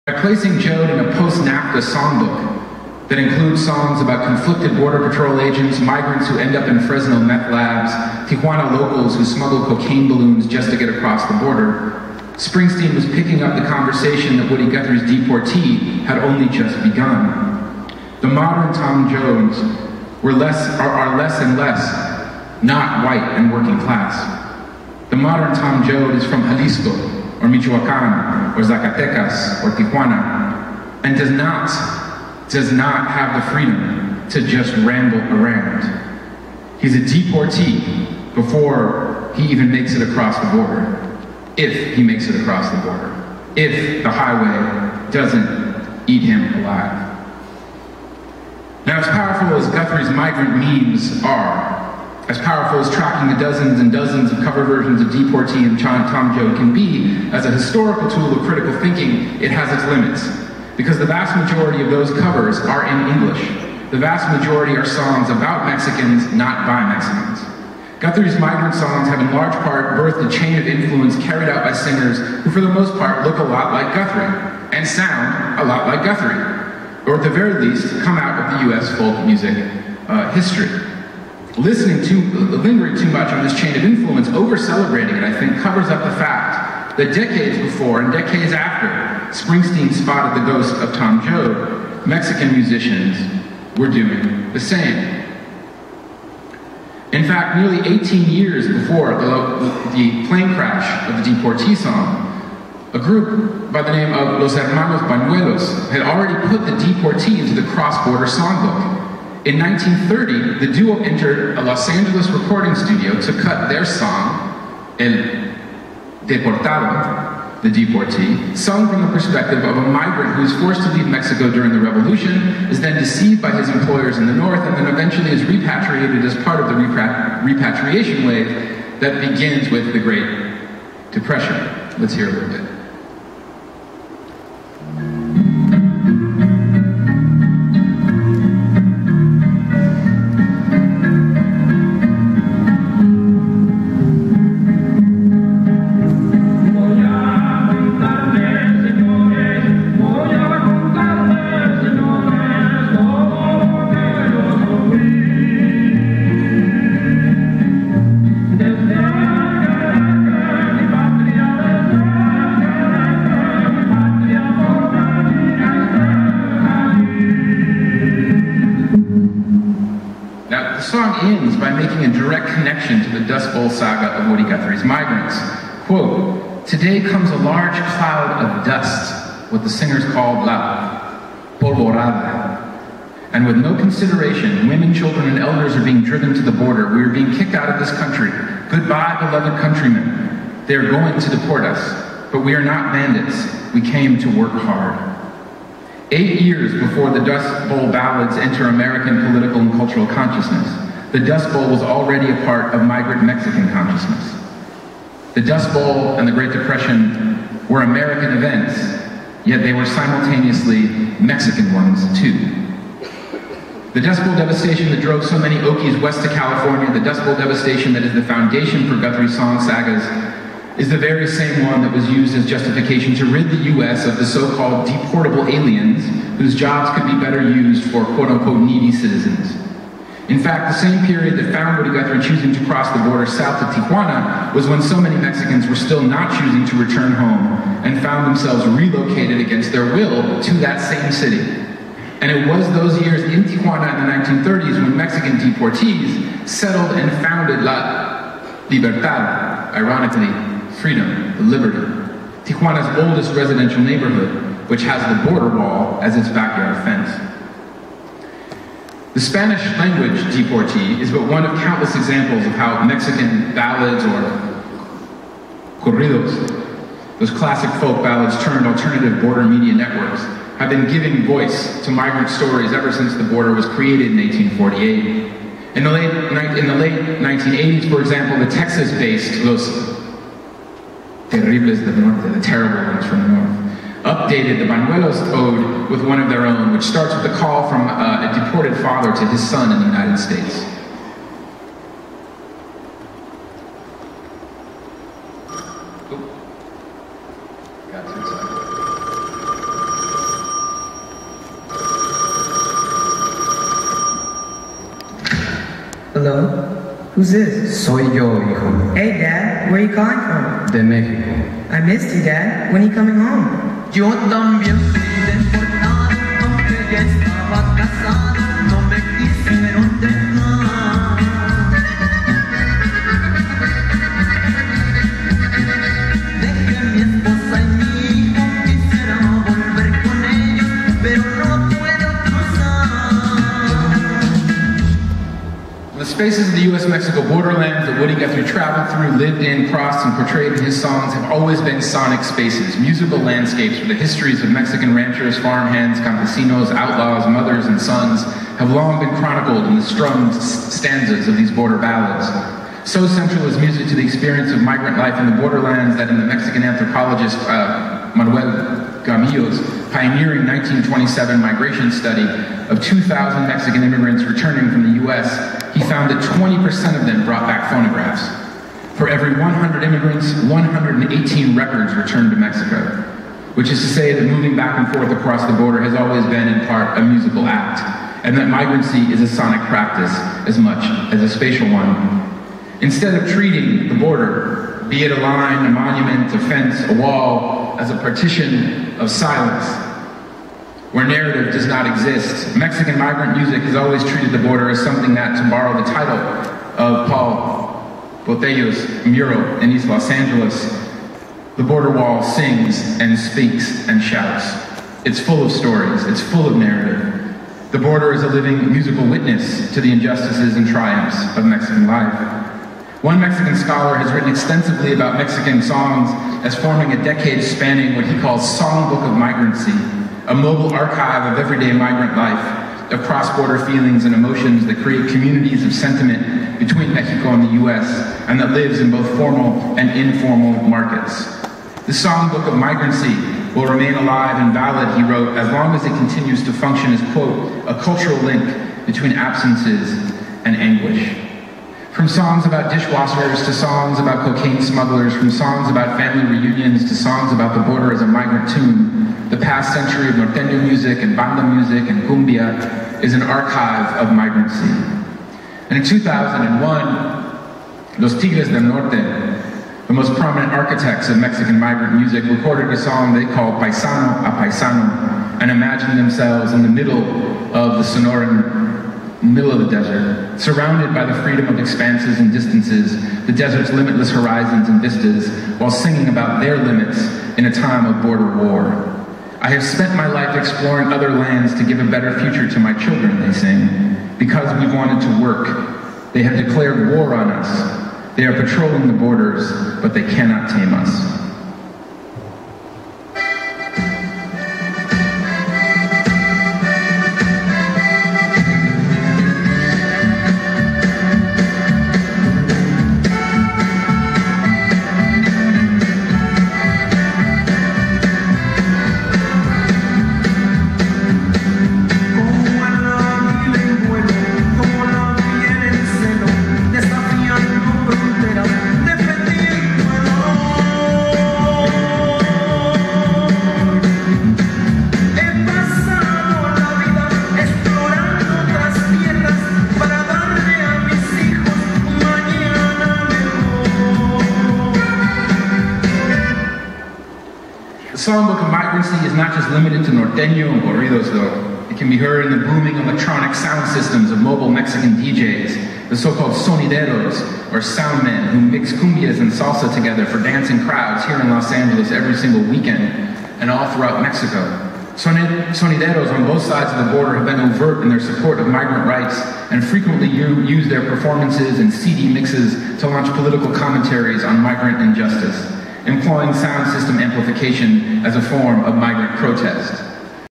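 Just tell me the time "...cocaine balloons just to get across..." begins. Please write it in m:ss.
0:09.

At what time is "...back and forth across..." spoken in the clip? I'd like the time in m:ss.
6:14.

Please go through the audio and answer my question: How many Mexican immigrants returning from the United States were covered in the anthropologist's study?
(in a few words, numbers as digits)
2,000.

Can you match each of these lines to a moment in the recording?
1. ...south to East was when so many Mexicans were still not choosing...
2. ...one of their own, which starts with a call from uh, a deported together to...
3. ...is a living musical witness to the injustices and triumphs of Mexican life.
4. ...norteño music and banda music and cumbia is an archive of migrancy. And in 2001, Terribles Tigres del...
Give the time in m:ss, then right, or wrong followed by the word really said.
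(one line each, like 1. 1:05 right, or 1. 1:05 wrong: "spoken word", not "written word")
1. 3:53 wrong: "Tijuana", not "East"
2. 4:46 wrong: "father", not "together"
3. 6:48 right
4. 7:30 wrong: "Los", not "Terribles".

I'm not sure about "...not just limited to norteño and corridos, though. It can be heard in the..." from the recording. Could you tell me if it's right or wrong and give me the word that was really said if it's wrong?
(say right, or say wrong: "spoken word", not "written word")
right.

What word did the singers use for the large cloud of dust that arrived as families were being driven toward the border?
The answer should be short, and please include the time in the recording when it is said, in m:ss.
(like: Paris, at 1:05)
la polvorada, at 3:00.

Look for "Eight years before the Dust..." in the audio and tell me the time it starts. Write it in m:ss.
3:16.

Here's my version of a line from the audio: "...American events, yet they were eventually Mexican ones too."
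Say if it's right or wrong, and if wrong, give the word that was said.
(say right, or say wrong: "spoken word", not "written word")
wrong: "simultaneously", not "eventually".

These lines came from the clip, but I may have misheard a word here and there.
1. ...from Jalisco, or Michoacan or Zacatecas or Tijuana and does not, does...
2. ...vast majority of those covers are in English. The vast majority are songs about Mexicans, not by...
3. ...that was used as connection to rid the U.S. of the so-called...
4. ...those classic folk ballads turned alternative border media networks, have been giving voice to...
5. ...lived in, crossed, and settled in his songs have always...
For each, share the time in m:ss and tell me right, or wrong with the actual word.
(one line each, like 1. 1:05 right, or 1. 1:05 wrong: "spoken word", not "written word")
1. 0:26 right
2. 1:01 right
3. 3:41 wrong: "justification", not "connection"
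4. 4:27 right
5. 5:39 wrong: "portrayed", not "settled".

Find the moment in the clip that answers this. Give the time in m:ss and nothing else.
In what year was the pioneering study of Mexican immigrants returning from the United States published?
6:00.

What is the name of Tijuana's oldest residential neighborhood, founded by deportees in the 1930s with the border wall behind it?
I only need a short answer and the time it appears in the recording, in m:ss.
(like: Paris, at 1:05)
La Libertad, at 4:07.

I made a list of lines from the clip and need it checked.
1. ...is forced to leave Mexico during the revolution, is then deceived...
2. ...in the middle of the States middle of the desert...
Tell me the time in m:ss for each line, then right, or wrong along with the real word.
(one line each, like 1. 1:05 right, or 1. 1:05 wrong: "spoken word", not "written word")
1. 2:00 right
2. 7:46 wrong: "Sonoran", not "States".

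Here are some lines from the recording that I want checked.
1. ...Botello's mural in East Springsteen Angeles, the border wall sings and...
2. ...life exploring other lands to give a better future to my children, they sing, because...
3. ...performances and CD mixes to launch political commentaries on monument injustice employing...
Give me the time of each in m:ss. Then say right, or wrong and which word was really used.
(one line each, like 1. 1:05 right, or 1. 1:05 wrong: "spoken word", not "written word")
1. 6:38 wrong: "Los", not "Springsteen"
2. 8:00 right
3. 9:20 wrong: "migrant", not "monument".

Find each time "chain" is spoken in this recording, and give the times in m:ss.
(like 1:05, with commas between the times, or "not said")
1:10, 1:23.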